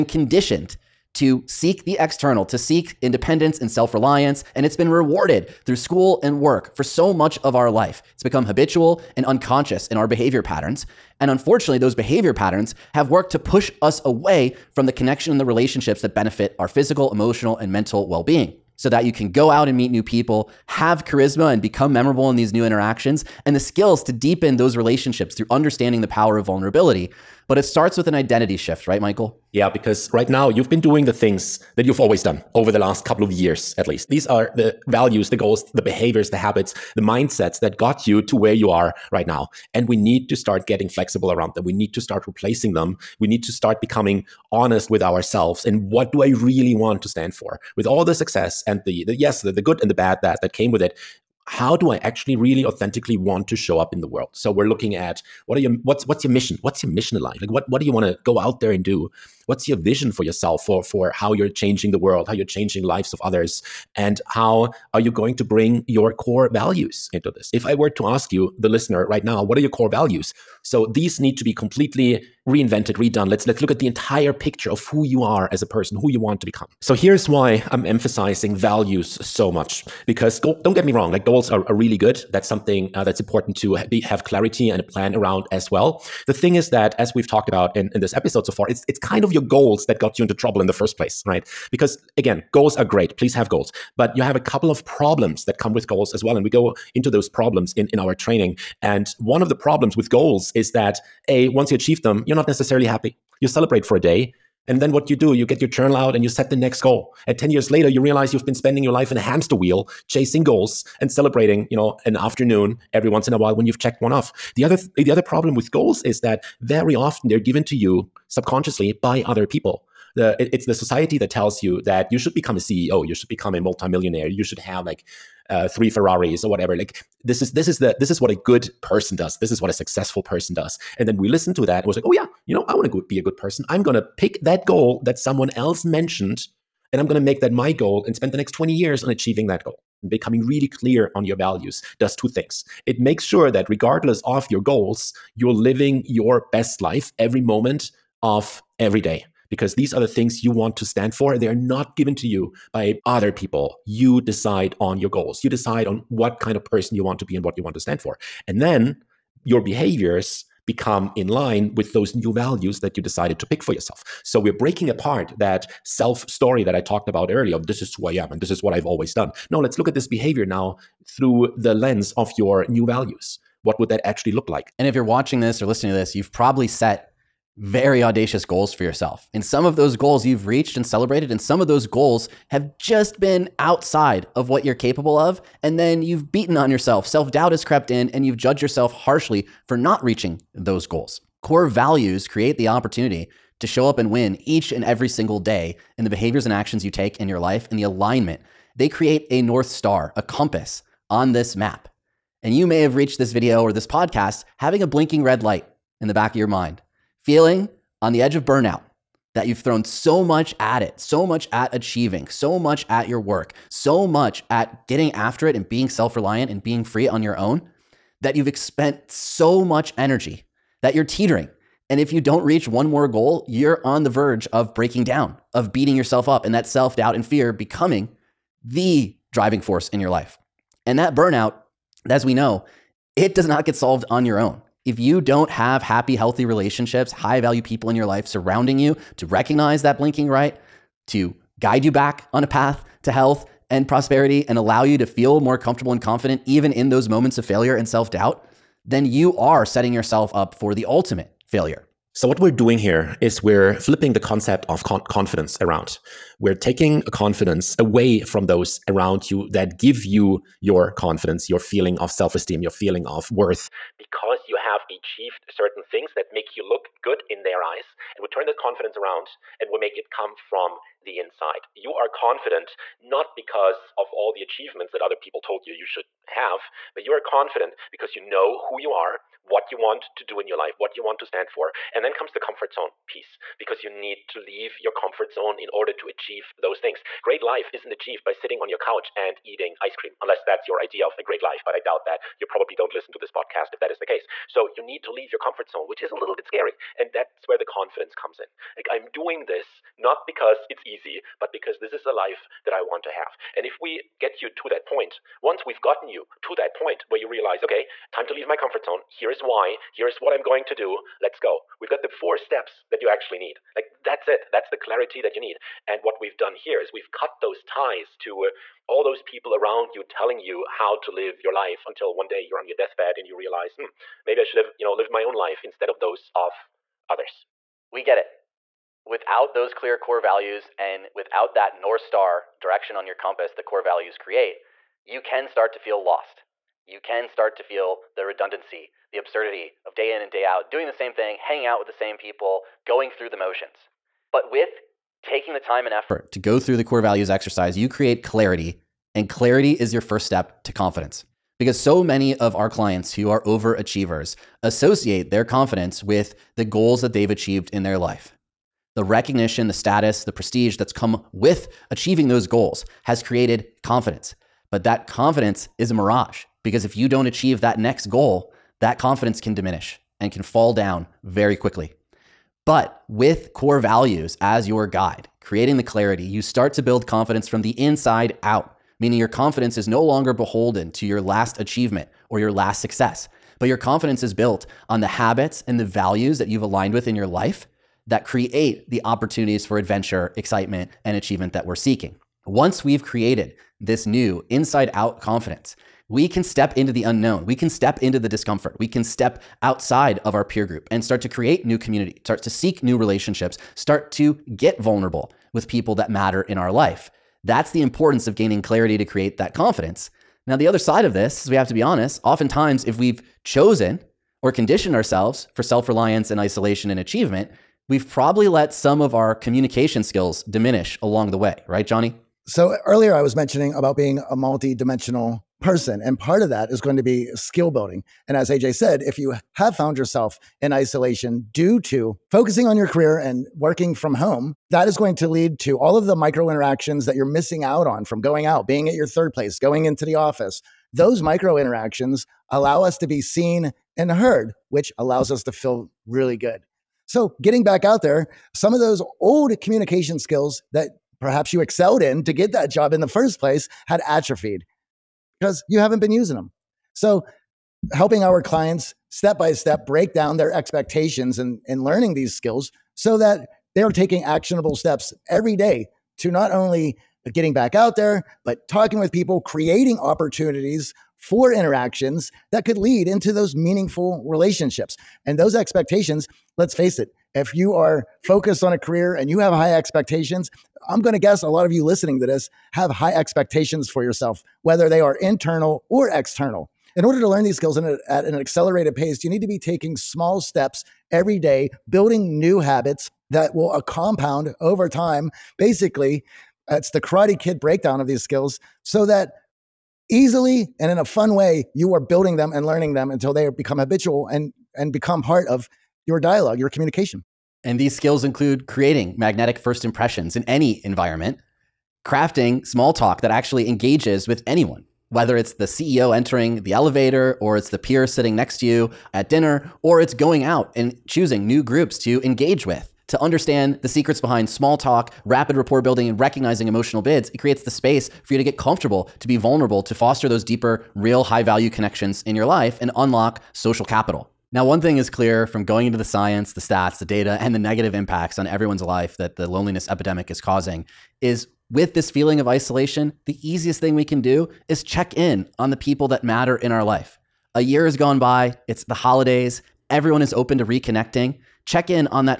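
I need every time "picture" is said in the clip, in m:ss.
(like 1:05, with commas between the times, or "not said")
1:14.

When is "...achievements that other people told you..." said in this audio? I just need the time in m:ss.
4:34.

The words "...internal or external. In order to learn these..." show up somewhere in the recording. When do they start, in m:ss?
8:05.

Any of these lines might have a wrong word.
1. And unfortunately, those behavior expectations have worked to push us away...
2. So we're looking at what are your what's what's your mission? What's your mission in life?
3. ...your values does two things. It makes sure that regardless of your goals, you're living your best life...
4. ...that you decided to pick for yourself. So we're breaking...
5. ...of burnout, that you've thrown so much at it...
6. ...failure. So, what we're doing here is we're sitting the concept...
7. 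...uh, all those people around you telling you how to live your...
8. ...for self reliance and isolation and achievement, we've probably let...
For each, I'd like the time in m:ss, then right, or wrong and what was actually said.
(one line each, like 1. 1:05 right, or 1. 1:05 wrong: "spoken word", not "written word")
1. 0:11 wrong: "patterns", not "expectations"
2. 0:54 right
3. 2:21 right
4. 2:42 right
5. 3:28 right
6. 4:11 wrong: "flipping", not "sitting"
7. 5:18 right
8. 6:55 right.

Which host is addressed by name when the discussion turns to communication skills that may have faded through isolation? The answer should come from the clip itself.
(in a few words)
Johnny.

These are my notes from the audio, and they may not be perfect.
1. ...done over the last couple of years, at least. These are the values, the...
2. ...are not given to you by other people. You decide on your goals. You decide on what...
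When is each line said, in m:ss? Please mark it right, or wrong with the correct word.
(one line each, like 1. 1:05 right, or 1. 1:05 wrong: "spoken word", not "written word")
1. 0:32 right
2. 2:31 right.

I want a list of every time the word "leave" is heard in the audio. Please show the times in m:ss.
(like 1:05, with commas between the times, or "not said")
4:44, 4:55, 5:08.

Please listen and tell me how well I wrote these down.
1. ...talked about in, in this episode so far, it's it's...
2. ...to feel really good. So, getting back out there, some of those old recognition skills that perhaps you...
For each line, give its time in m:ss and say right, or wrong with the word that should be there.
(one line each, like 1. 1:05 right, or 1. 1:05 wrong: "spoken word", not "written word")
1. 1:27 right
2. 7:25 wrong: "communication", not "recognition".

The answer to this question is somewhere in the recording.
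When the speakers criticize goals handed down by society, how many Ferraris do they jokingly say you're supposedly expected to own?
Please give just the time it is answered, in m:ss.
2:05.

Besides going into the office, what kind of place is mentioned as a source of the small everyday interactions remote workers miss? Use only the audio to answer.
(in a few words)
third place.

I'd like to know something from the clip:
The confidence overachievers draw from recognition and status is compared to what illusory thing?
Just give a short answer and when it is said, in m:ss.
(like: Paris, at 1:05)
a mirage, at 6:05.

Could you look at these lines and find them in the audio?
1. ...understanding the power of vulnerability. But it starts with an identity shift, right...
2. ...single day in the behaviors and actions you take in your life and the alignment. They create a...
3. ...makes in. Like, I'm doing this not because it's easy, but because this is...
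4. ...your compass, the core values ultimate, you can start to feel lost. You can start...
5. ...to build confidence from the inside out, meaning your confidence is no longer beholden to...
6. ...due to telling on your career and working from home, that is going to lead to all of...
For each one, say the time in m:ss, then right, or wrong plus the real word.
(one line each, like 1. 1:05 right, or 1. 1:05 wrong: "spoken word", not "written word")
1. 0:25 right
2. 3:15 right
3. 4:58 wrong: "comes", not "makes"
4. 5:33 wrong: "create", not "ultimate"
5. 6:16 right
6. 7:11 wrong: "focusing", not "telling".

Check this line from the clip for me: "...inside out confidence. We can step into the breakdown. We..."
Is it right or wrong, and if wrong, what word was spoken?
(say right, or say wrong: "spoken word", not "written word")
wrong: "unknown", not "breakdown".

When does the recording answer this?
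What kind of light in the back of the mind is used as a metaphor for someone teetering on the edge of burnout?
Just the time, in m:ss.
3:24.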